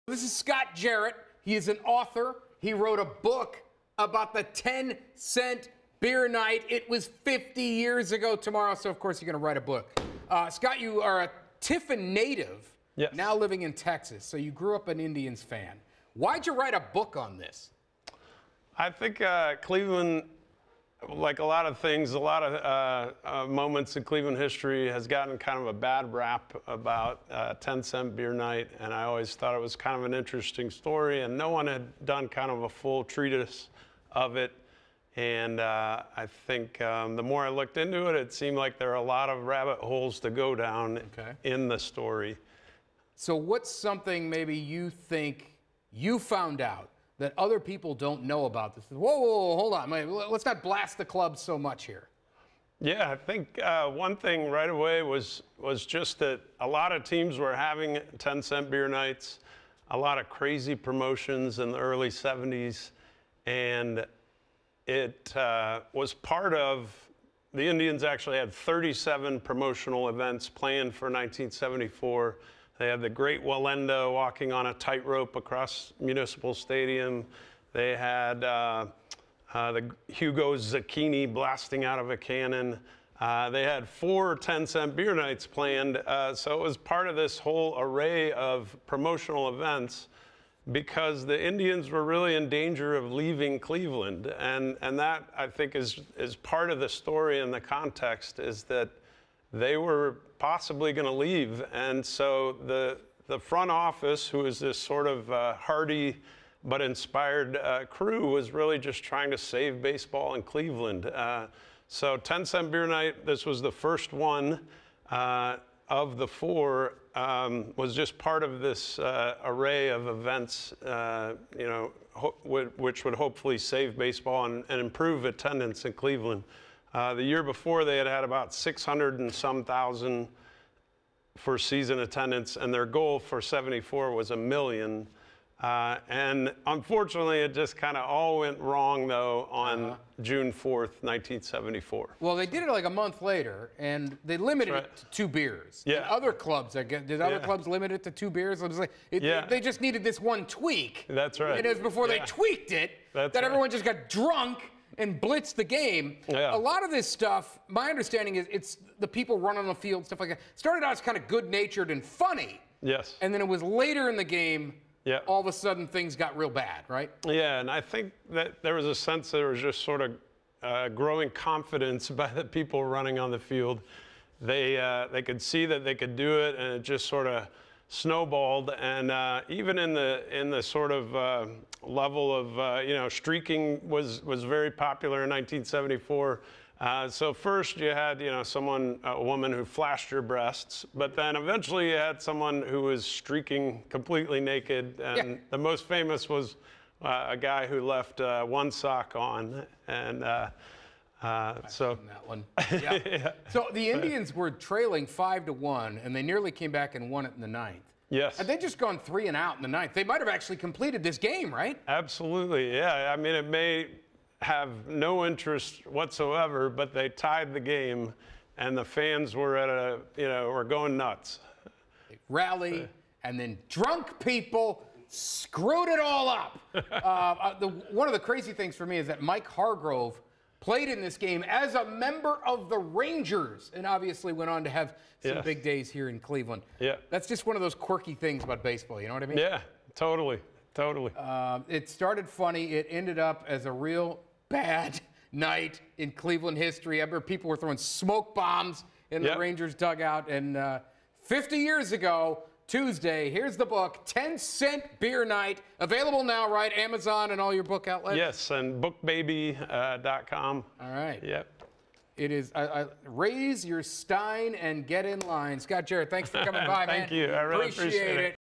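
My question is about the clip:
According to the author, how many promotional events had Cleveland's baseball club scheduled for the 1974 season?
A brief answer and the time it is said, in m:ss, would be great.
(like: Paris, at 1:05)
37, at 1:08.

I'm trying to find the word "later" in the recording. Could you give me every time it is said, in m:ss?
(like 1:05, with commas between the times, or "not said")
2:23, 2:43.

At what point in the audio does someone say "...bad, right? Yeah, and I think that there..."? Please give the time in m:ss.
2:46.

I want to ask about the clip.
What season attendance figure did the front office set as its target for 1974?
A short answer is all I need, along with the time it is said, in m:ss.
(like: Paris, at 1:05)
1 million, at 2:14.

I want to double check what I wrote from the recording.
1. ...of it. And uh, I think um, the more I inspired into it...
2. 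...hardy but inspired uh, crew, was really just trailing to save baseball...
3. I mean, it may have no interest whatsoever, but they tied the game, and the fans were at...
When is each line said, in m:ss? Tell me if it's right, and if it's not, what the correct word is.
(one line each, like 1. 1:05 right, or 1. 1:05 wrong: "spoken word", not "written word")
1. 0:34 wrong: "looked", not "inspired"
2. 1:45 wrong: "trying", not "trailing"
3. 3:33 right.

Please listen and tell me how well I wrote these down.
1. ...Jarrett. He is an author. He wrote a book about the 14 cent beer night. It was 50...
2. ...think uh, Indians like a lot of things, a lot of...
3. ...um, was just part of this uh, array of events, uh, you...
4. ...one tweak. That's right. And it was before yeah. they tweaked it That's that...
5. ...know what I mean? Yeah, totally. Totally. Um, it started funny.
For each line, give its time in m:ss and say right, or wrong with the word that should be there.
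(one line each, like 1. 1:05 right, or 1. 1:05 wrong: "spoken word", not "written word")
1. 0:00 wrong: "10", not "14"
2. 0:18 wrong: "Cleveland", not "Indians"
3. 1:57 right
4. 2:30 right
5. 3:59 right.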